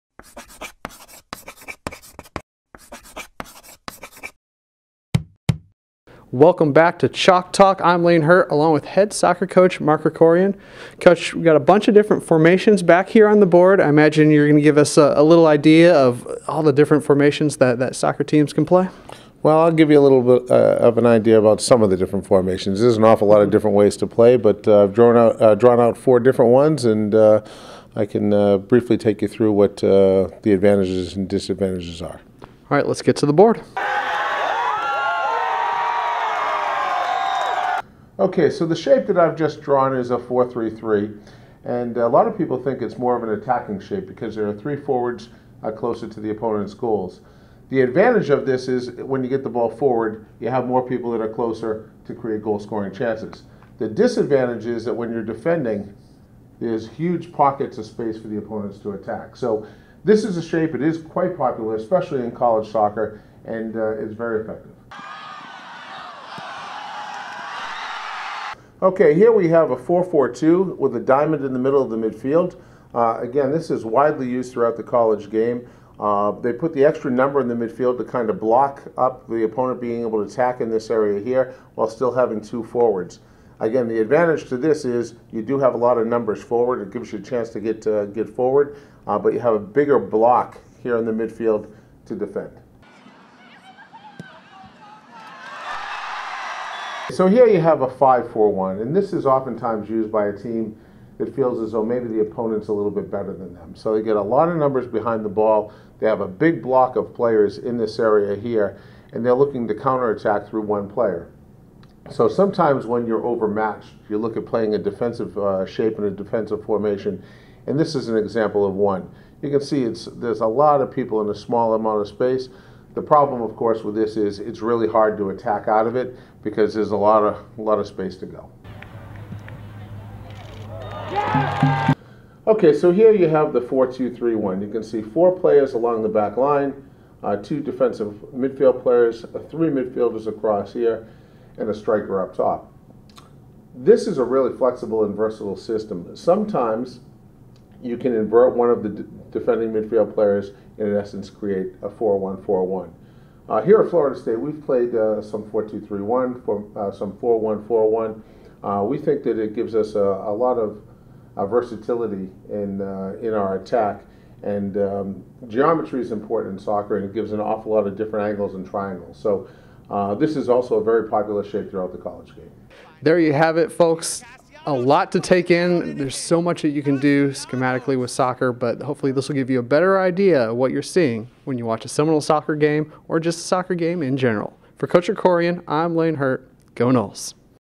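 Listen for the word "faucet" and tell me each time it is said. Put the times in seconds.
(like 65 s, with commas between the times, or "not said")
not said.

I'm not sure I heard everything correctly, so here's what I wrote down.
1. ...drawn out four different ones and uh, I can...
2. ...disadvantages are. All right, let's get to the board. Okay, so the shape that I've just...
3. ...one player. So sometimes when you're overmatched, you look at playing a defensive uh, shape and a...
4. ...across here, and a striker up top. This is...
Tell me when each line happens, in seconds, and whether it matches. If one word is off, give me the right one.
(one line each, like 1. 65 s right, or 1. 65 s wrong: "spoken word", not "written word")
1. 25 s right
2. 31 s right
3. 110 s right
4. 140 s right.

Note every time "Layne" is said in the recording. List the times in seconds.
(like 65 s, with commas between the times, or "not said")
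8 s, 185 s.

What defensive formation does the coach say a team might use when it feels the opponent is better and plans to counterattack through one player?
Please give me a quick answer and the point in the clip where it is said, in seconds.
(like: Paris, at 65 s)
5-4-1, at 97 s.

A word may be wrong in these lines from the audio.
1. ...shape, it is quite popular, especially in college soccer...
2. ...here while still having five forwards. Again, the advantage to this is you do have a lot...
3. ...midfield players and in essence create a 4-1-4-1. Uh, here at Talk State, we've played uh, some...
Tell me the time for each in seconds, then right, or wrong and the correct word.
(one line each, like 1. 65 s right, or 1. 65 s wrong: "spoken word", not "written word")
1. 60 s right
2. 81 s wrong: "two", not "five"
3. 149 s wrong: "Florida", not "Talk".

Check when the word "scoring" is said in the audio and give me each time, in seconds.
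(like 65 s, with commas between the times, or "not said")
52 s.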